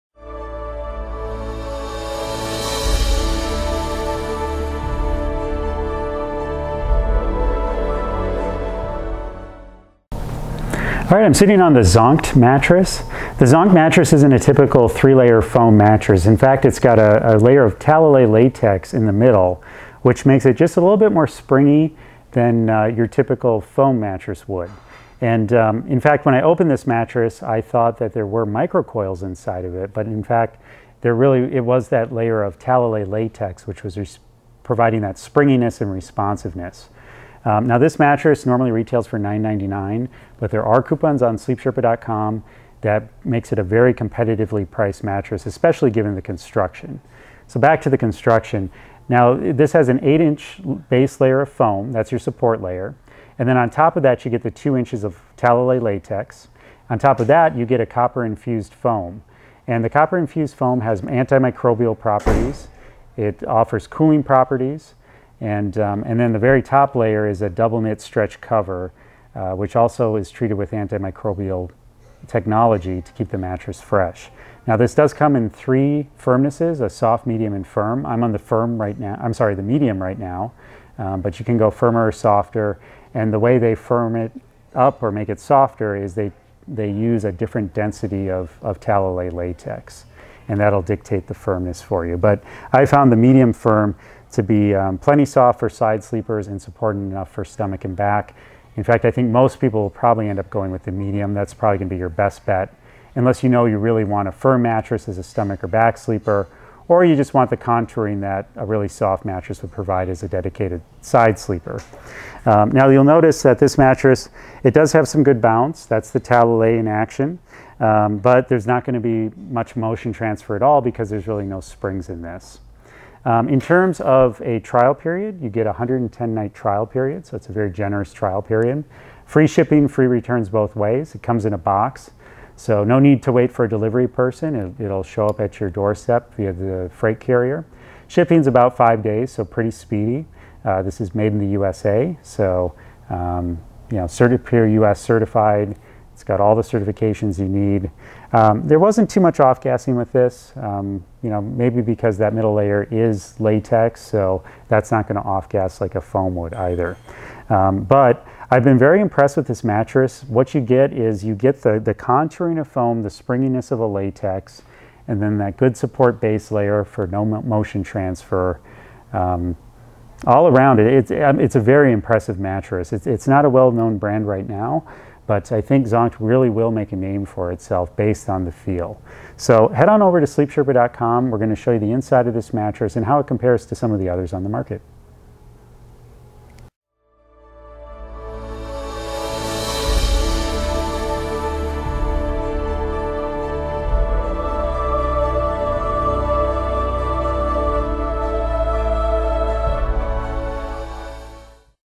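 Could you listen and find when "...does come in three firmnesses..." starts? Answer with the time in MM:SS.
01:14.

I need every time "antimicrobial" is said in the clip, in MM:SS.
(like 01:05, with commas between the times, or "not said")
01:01, 01:10.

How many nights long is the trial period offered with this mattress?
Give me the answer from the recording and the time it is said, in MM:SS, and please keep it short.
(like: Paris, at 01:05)
110, at 02:05.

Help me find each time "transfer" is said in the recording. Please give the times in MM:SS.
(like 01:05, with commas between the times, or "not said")
02:00, 02:47.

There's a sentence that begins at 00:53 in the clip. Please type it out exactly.
And then on top of that, you get the two inches of Talalay latex.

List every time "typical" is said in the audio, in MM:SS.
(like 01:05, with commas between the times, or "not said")
00:14, 00:23.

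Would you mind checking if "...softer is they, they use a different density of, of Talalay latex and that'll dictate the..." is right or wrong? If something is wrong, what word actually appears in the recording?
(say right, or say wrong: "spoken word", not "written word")
right.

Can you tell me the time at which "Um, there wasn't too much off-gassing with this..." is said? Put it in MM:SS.
02:28.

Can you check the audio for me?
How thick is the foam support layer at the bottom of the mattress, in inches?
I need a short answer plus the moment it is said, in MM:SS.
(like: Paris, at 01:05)
8 inches, at 00:50.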